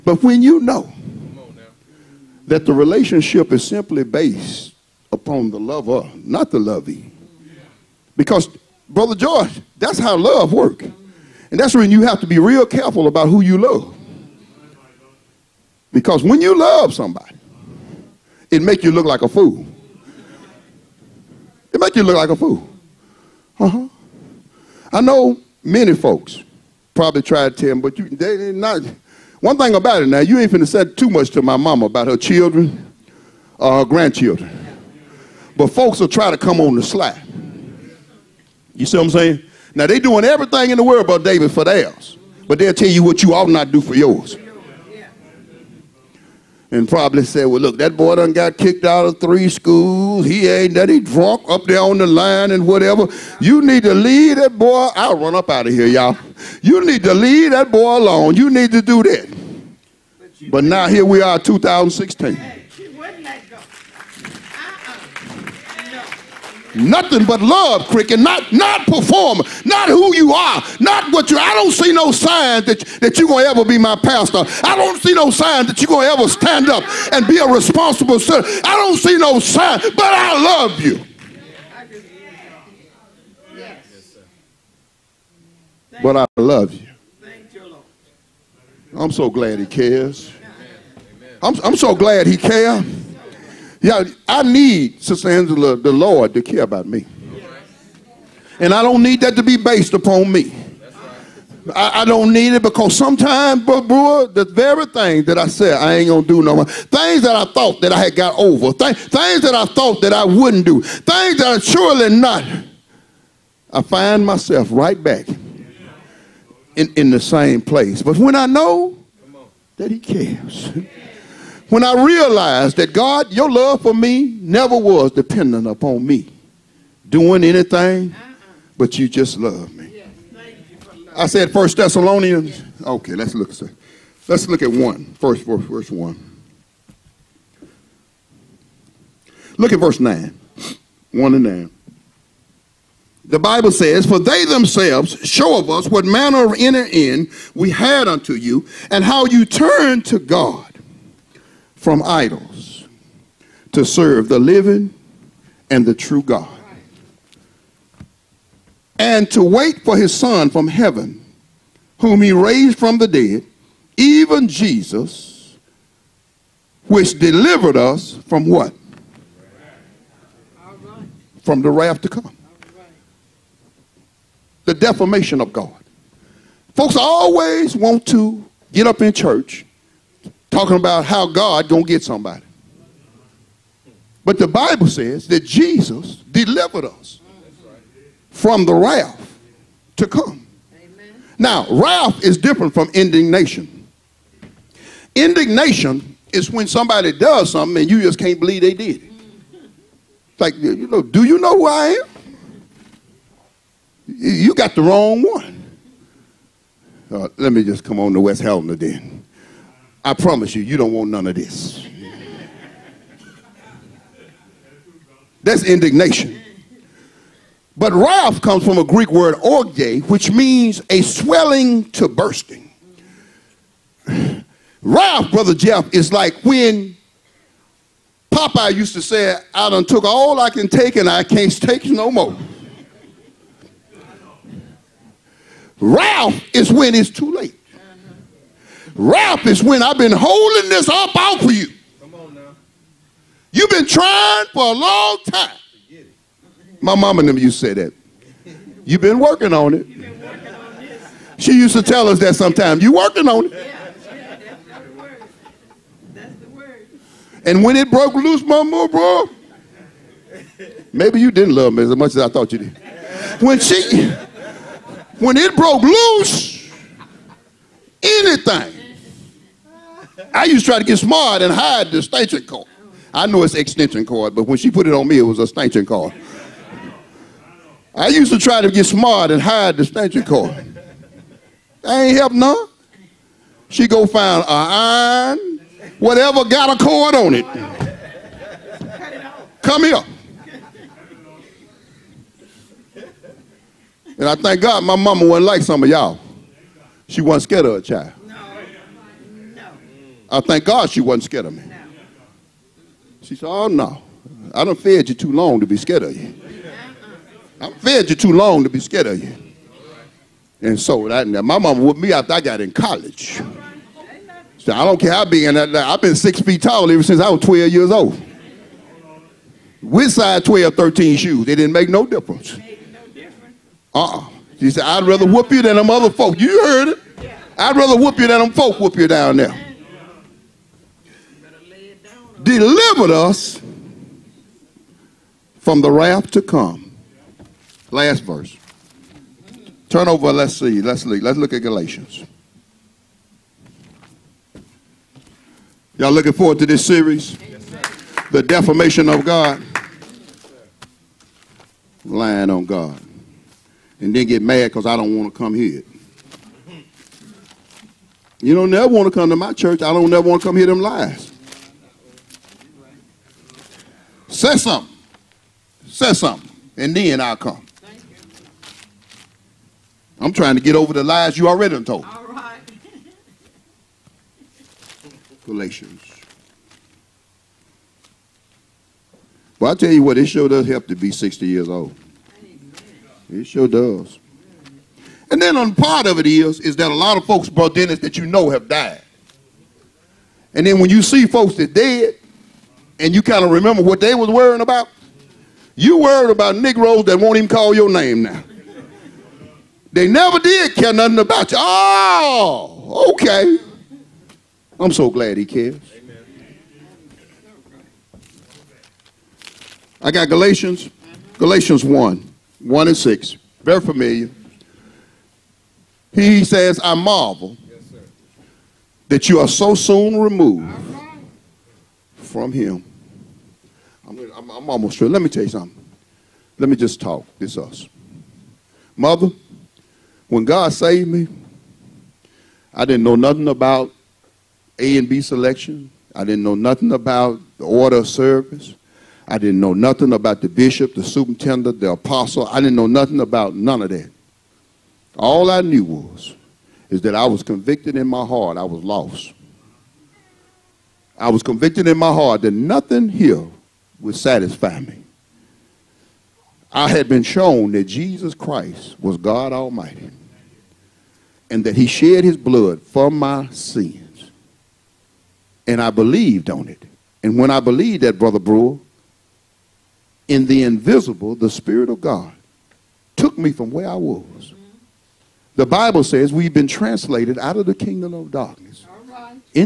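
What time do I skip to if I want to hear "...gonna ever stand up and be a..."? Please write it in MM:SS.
01:15.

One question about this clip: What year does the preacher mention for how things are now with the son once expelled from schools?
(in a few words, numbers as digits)
2016.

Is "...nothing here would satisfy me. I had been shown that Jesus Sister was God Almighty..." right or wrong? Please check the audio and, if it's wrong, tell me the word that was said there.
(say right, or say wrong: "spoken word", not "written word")
wrong: "Christ", not "Sister".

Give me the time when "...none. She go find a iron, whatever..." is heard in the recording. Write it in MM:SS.
04:42.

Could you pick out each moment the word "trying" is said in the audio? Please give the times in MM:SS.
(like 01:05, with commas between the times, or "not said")
04:03, 06:10.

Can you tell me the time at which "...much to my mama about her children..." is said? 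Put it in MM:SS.
00:31.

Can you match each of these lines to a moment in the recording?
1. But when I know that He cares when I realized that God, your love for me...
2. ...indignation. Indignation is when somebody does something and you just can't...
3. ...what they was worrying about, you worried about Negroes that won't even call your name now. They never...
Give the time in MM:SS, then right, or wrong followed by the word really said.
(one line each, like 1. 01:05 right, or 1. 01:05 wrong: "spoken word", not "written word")
1. 01:58 right
2. 03:12 right
3. 06:33 right.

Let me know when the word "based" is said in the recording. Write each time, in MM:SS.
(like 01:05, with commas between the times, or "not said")
00:04, 01:39.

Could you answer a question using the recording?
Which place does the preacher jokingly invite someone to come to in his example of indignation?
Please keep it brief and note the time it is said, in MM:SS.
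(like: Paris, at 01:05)
West Helena, at 03:28.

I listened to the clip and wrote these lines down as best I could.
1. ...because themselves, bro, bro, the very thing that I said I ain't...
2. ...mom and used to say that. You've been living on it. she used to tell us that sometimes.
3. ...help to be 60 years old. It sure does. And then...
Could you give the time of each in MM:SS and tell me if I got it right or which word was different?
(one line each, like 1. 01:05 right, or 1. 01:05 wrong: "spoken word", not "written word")
1. 01:42 wrong: "sometimes", not "themselves"
2. 04:06 wrong: "working", not "living"
3. 06:20 right.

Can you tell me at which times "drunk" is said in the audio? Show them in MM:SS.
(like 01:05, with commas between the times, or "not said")
00:51.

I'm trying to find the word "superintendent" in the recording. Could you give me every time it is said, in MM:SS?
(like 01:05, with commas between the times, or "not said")
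07:21.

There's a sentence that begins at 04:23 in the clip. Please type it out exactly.
When she, when it broke loose, anything I used to try to get smart and hide the extension cord.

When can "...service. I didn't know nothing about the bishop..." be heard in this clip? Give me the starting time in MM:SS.
07:18.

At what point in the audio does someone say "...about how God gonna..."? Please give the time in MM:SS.
03:00.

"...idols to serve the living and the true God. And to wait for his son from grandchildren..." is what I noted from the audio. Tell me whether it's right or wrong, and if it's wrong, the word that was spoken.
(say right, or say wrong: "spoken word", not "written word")
wrong: "heaven", not "grandchildren".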